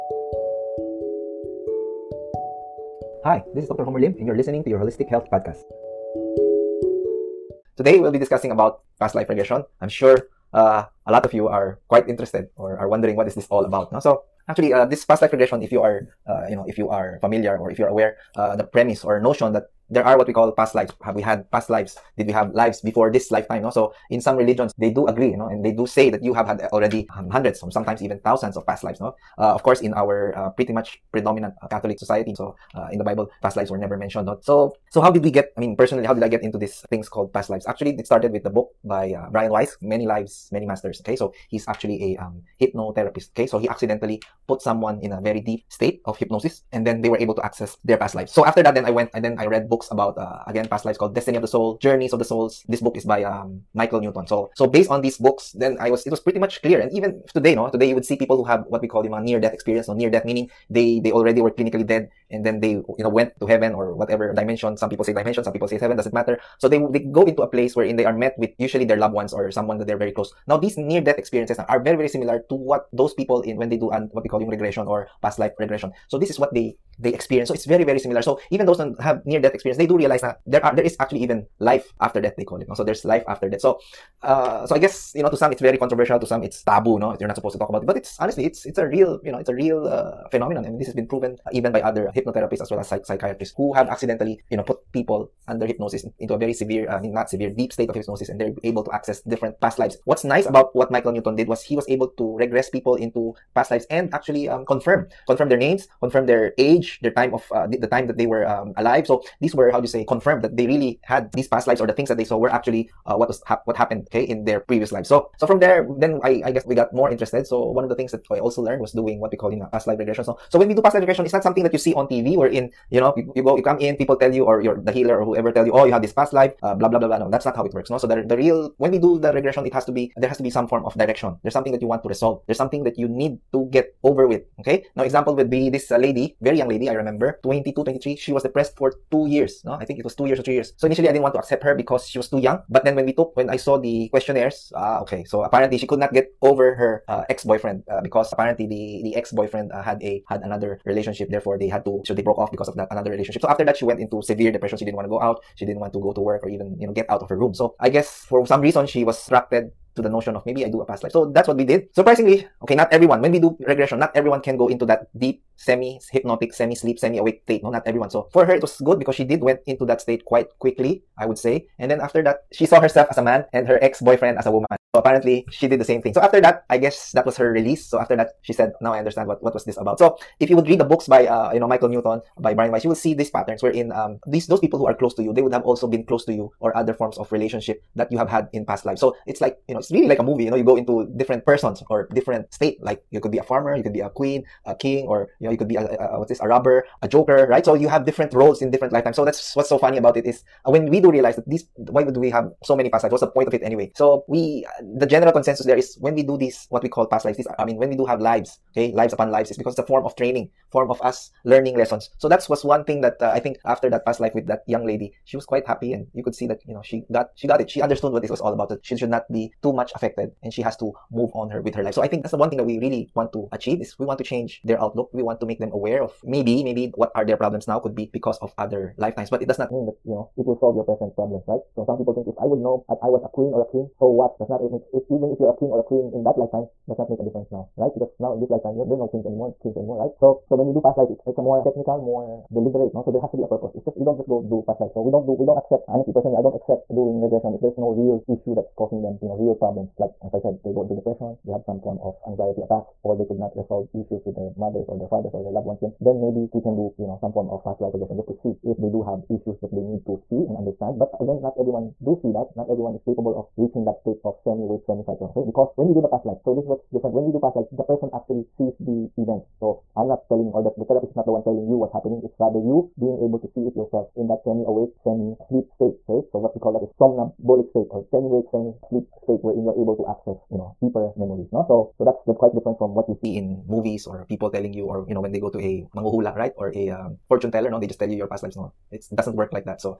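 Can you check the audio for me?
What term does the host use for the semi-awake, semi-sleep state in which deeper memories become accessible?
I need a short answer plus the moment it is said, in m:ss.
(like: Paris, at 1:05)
somnambulic state, at 4:36.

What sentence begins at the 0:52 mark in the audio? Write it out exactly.
This book is by, um, Michael Newton.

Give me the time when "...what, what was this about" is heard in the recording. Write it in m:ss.
2:59.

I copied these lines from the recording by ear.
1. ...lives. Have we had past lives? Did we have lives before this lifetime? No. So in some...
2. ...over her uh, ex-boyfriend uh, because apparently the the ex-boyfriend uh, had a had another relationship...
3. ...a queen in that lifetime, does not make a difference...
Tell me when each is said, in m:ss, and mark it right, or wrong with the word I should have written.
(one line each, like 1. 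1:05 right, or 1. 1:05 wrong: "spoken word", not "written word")
1. 0:20 right
2. 2:26 right
3. 3:55 right.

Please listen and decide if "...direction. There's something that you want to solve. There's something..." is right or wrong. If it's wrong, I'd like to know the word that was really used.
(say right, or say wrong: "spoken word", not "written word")
wrong: "resolve", not "solve".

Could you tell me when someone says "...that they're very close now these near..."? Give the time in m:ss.
1:09.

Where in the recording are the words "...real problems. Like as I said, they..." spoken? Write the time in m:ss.
4:09.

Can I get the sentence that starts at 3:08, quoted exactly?
So it's like you know, it's really like a movie.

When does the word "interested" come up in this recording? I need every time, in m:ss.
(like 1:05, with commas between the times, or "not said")
0:12, 1:57.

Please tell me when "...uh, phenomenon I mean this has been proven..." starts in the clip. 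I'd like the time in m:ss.
1:29.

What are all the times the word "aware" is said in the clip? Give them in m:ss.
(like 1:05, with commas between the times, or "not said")
0:17, 3:45.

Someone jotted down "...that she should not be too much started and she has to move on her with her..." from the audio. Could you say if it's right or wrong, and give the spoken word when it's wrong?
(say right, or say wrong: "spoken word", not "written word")
wrong: "affected", not "started".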